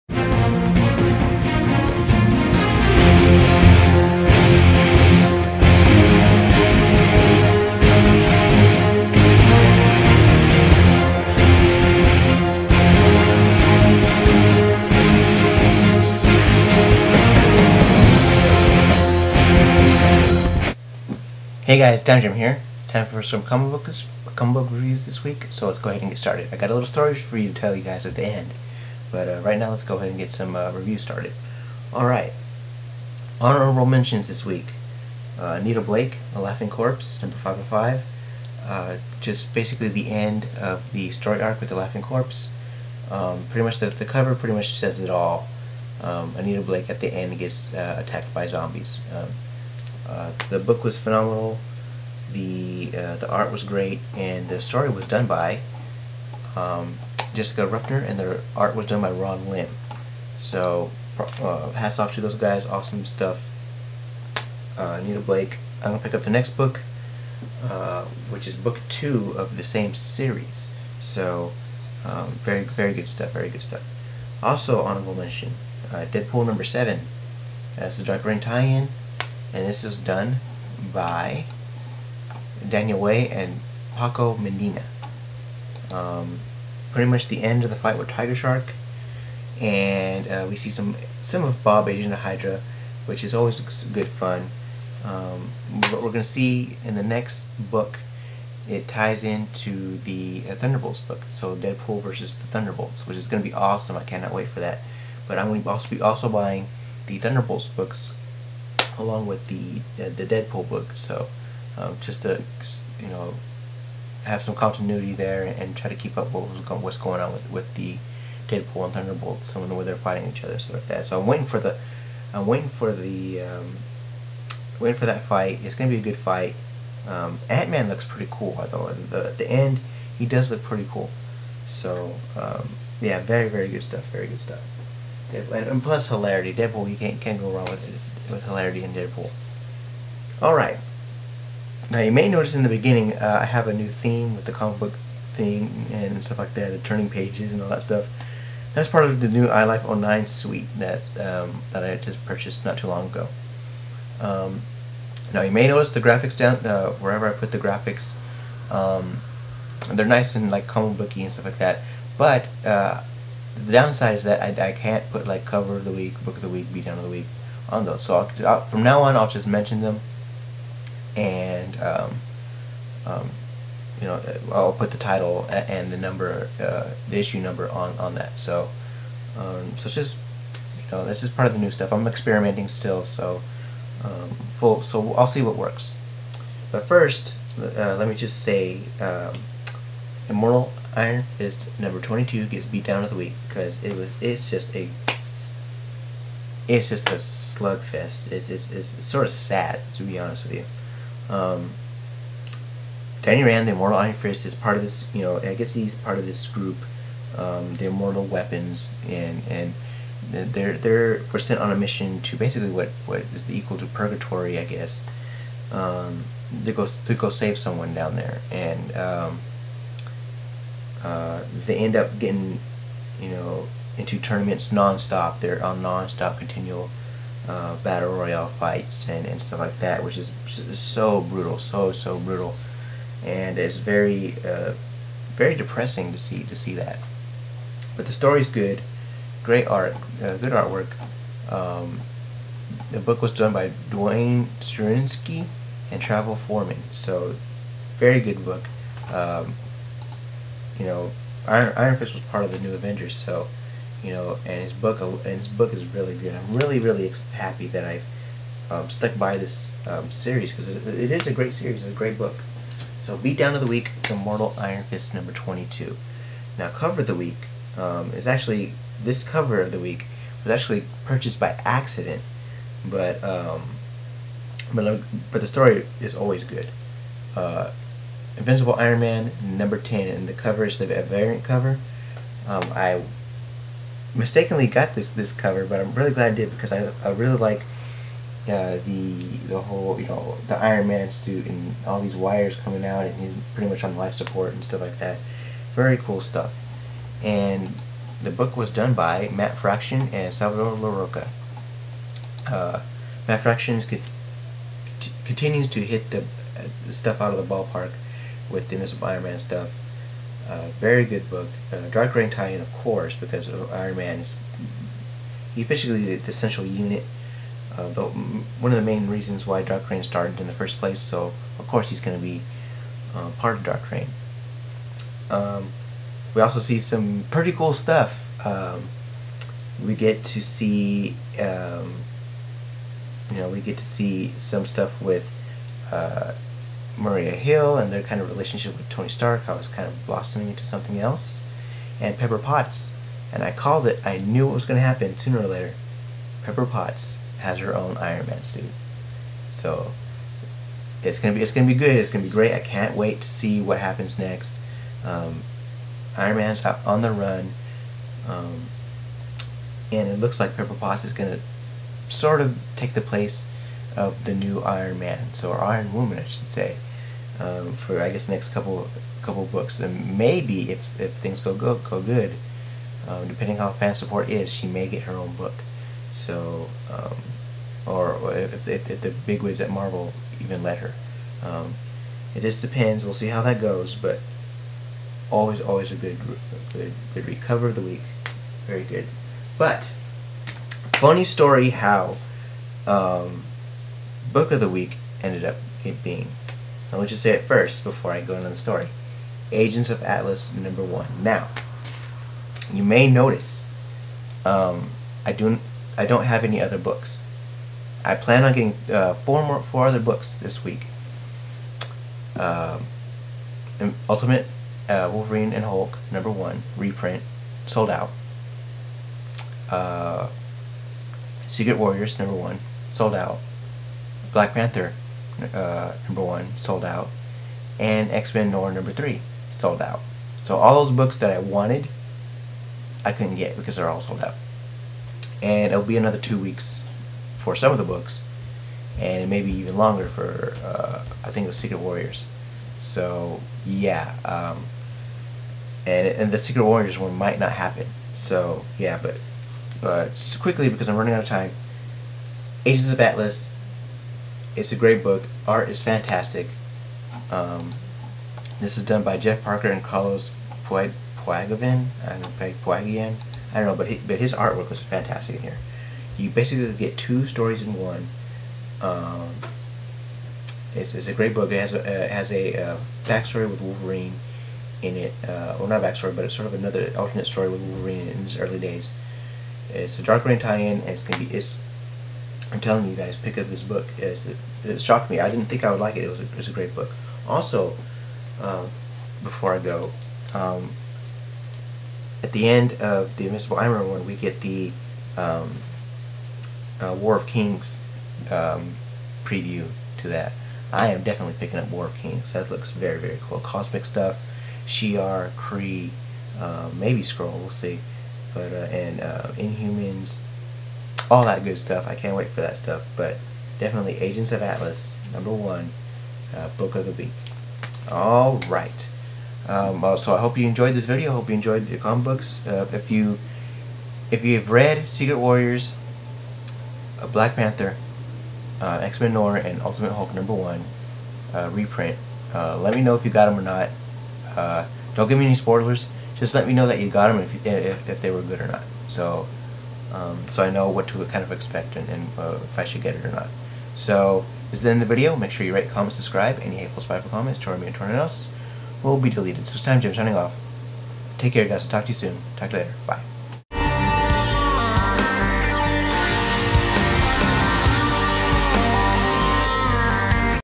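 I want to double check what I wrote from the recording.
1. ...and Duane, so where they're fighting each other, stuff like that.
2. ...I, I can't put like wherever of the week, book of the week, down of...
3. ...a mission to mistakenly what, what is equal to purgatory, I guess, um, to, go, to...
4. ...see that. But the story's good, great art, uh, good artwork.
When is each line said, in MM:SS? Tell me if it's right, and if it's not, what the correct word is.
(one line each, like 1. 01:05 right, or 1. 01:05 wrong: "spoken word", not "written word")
1. 01:58 wrong: "Thunderbolt", not "Duane"
2. 02:44 wrong: "cover", not "wherever"
3. 03:31 wrong: "basically", not "mistakenly"
4. 03:56 right.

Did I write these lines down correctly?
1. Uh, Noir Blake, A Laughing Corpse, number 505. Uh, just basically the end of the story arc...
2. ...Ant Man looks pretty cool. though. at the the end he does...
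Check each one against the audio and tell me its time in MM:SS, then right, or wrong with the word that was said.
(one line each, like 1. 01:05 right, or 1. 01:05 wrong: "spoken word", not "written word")
1. 00:35 wrong: "Anita", not "Noir"
2. 02:07 right.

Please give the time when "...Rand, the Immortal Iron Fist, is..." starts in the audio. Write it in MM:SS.
03:23.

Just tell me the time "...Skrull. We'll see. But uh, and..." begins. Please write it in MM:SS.
08:27.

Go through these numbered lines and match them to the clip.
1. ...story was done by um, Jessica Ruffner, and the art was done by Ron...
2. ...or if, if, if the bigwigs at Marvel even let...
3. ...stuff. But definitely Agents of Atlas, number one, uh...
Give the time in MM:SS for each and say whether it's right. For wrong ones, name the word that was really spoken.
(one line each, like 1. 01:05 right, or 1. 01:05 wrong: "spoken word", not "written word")
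1. 00:54 right
2. 06:17 right
3. 08:32 right.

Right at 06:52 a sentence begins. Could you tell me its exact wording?
Um, Ultimate uh, Wolverine and Hulk number one reprint sold out.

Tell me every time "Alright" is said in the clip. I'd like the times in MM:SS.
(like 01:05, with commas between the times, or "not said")
00:31, 02:20.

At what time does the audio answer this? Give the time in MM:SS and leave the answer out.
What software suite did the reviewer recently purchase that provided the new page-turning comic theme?
02:29.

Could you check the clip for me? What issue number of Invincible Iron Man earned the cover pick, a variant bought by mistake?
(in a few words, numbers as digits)
10.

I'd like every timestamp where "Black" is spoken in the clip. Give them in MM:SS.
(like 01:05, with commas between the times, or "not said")
07:04, 08:47.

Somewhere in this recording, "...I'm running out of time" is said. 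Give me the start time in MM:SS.
07:30.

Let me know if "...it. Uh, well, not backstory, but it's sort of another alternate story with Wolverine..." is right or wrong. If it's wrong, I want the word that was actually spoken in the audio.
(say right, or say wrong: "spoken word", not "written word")
right.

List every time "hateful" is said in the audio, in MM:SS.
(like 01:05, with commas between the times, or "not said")
09:06.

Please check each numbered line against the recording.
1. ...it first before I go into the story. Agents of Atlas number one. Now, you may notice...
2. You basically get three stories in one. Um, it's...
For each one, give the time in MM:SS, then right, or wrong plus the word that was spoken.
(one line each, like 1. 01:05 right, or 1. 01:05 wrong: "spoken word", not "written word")
1. 06:37 right
2. 07:46 wrong: "two", not "three".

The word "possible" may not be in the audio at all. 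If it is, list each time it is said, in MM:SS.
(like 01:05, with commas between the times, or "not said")
not said.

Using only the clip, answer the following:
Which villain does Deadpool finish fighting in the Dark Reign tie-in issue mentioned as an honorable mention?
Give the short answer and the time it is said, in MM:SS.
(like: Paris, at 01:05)
Tiger Shark, at 01:28.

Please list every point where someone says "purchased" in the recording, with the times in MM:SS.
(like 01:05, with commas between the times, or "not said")
02:32, 04:31.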